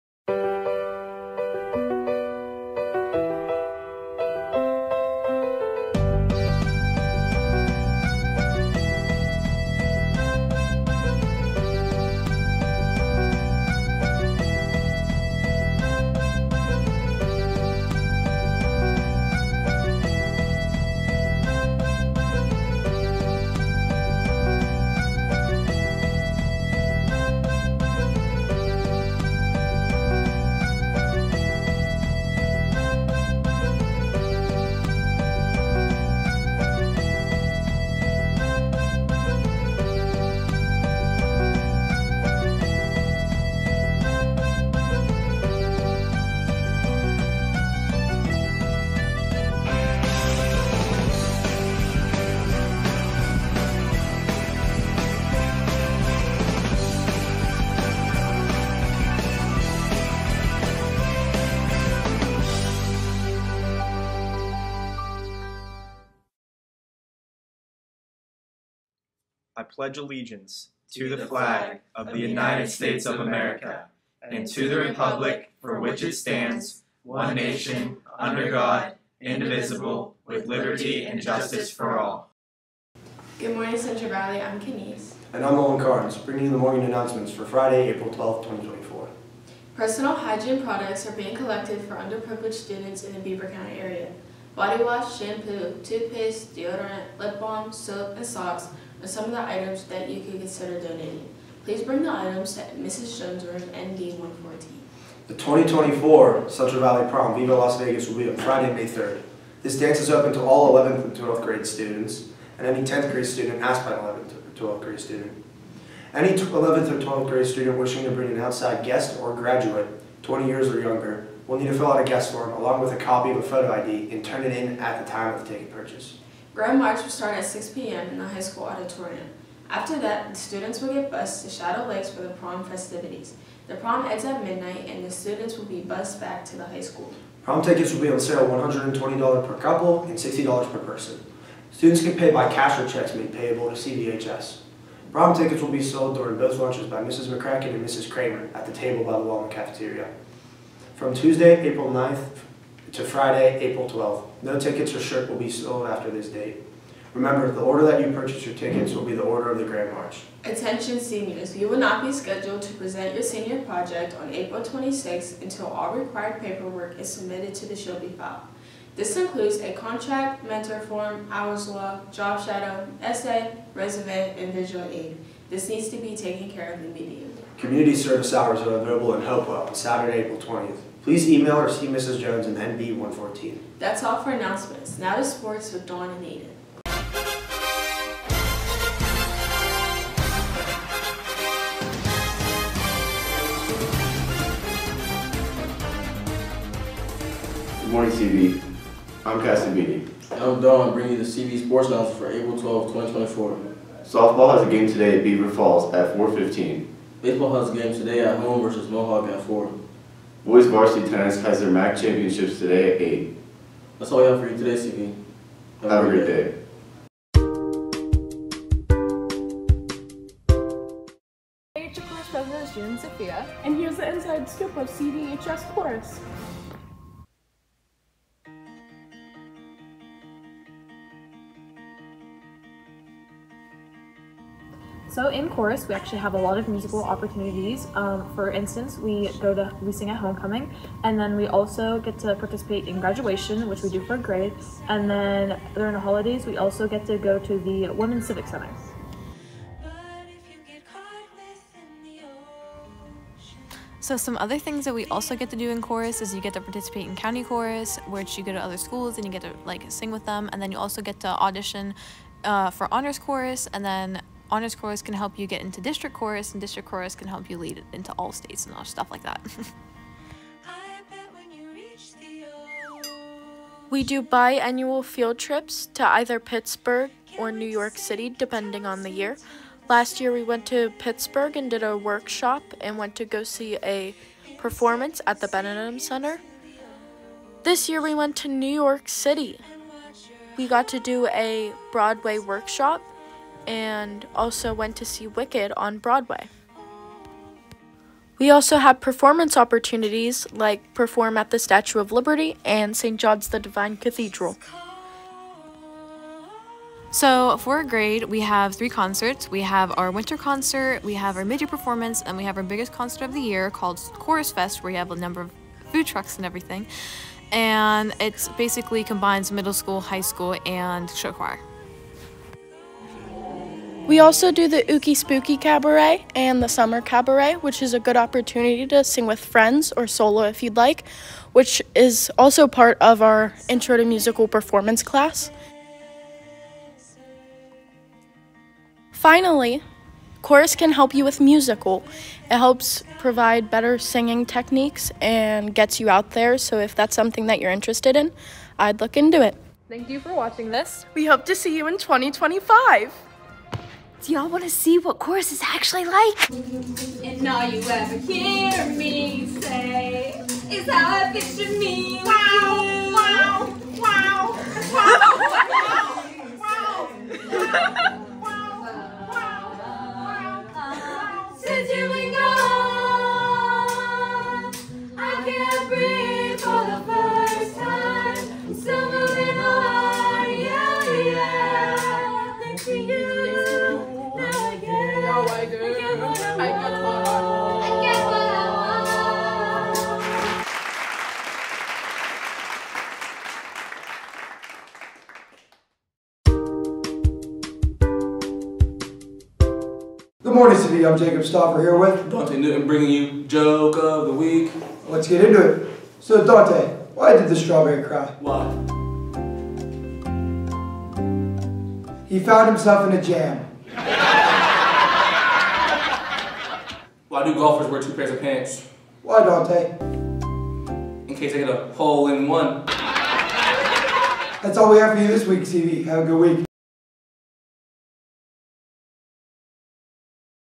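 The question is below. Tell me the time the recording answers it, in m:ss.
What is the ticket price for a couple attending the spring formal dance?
2:18.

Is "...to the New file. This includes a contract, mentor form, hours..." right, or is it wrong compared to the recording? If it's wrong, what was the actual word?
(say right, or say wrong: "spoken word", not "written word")
wrong: "Shelby", not "New".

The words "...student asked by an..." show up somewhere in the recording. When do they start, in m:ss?
1:53.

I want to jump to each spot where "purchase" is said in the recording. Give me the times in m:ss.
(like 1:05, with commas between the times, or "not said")
2:05, 2:38.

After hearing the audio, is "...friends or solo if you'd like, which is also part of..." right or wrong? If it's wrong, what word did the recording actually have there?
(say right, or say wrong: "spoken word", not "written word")
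right.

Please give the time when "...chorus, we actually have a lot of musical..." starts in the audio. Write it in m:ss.
3:55.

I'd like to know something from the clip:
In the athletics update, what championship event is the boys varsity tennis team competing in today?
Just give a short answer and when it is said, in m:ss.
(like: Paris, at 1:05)
MAC championships, at 3:31.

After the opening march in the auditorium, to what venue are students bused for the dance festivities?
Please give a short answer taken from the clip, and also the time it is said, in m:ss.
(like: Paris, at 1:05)
Shadow Lakes, at 2:11.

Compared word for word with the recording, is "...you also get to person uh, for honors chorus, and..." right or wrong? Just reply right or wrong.
wrong.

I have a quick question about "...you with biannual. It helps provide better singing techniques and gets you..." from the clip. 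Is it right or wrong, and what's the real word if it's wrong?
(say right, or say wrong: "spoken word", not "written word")
wrong: "musical", not "biannual".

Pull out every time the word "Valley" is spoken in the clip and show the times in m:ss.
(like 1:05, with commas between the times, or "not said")
1:24, 1:46.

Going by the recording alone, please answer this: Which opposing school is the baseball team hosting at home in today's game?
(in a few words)
Mohawk.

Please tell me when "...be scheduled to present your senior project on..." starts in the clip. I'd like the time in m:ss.
2:42.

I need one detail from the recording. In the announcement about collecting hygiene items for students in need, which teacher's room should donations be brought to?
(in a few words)
Mrs. Jones' room.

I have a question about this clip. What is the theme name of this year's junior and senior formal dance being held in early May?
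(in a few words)
Viva Las Vegas.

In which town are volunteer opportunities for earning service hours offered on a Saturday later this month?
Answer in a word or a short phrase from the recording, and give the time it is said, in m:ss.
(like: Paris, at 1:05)
Hopewell, at 2:59.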